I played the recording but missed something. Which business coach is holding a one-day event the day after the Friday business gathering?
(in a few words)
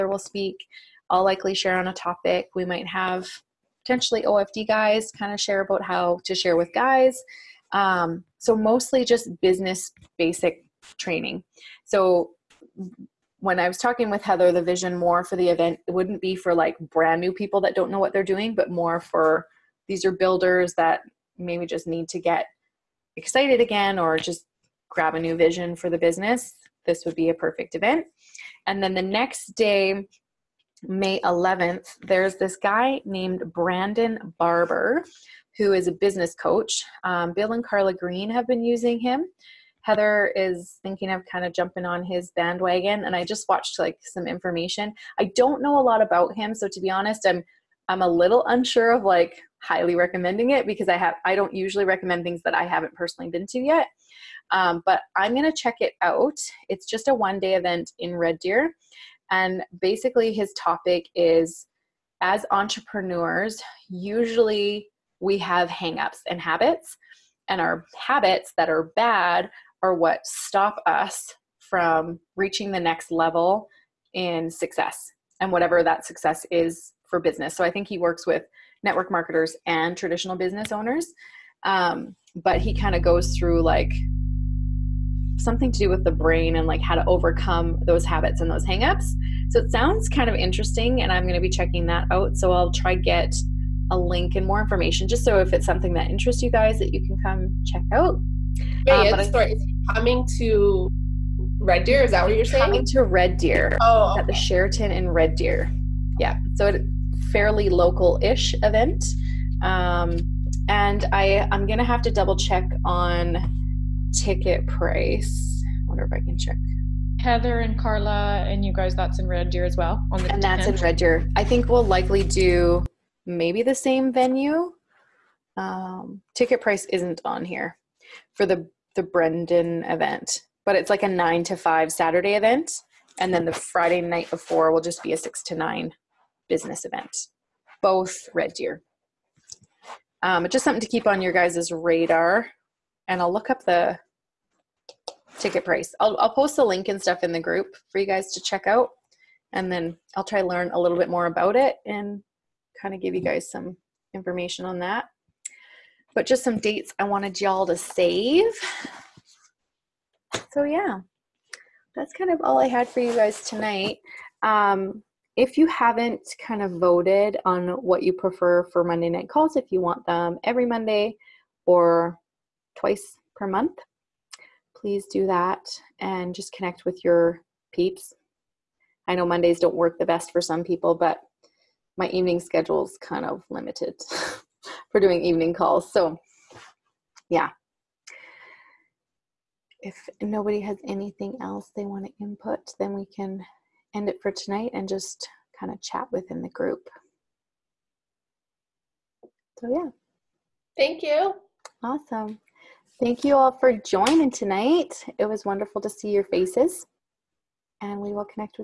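Brandon Barber.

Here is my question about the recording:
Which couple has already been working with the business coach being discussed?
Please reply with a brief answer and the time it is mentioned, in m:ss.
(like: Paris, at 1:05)
Bill and Carla Green, at 0:37.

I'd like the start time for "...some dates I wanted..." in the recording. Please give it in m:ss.
2:36.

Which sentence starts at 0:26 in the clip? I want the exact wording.
This would be a perfect event.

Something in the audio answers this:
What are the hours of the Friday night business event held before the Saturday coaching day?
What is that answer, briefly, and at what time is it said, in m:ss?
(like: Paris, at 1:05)
6 to 9, at 2:15.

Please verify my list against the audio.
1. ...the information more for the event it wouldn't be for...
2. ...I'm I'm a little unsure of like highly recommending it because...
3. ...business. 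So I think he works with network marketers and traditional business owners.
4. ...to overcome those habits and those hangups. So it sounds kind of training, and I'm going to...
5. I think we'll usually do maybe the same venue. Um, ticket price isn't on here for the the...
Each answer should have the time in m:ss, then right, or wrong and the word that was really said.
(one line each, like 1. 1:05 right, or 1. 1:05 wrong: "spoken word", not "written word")
1. 0:14 wrong: "vision", not "information"
2. 0:47 right
3. 1:17 right
4. 1:26 wrong: "interesting", not "training"
5. 2:01 wrong: "likely", not "usually".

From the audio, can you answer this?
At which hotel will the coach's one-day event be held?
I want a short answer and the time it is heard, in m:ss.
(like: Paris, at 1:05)
Sheraton, at 1:44.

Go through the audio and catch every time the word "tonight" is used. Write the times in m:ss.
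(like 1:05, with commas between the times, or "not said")
2:43, 3:14, 3:24.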